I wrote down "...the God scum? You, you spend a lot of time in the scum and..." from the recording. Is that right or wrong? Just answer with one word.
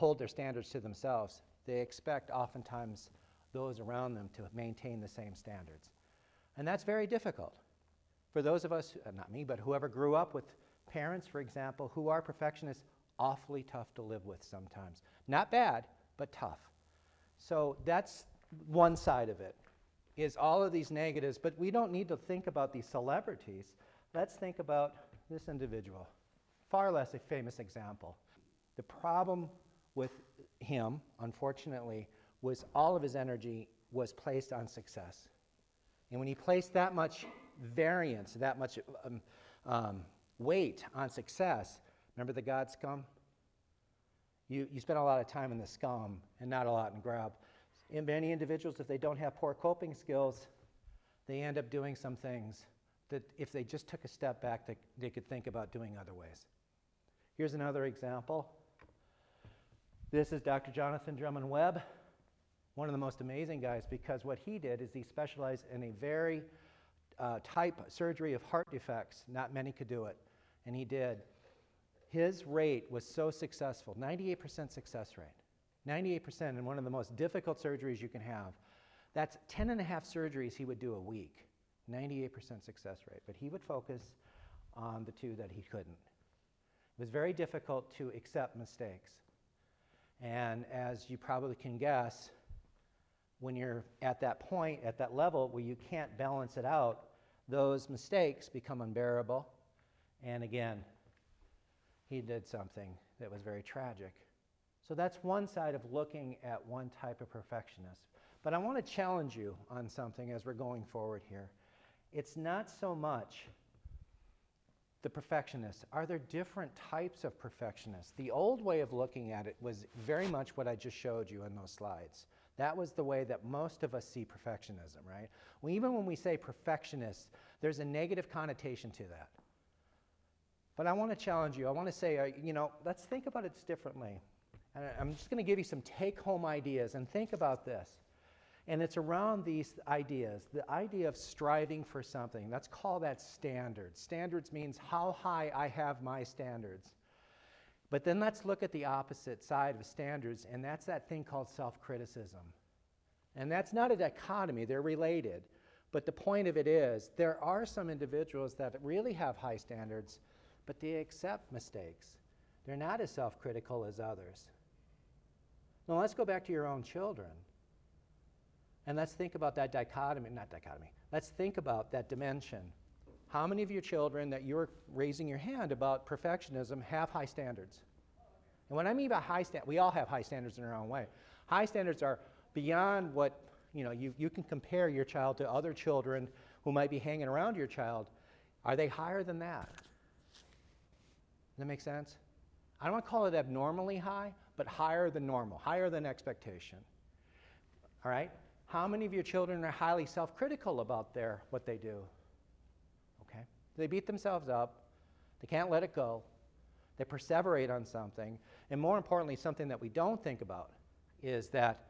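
right.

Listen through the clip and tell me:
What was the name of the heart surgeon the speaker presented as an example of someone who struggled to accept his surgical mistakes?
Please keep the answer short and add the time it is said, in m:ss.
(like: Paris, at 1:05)
Jonathan Drummond Webb, at 1:00.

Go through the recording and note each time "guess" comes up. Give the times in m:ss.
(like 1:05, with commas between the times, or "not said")
1:31.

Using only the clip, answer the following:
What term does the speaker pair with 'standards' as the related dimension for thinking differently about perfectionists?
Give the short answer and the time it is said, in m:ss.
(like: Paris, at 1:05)
self criticism, at 2:31.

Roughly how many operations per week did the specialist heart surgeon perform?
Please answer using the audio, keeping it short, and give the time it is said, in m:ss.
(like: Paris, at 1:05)
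10 and a half, at 1:19.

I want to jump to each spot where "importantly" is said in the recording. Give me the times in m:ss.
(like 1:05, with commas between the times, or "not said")
3:28.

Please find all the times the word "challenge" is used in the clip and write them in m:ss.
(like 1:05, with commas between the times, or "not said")
1:48, 2:11.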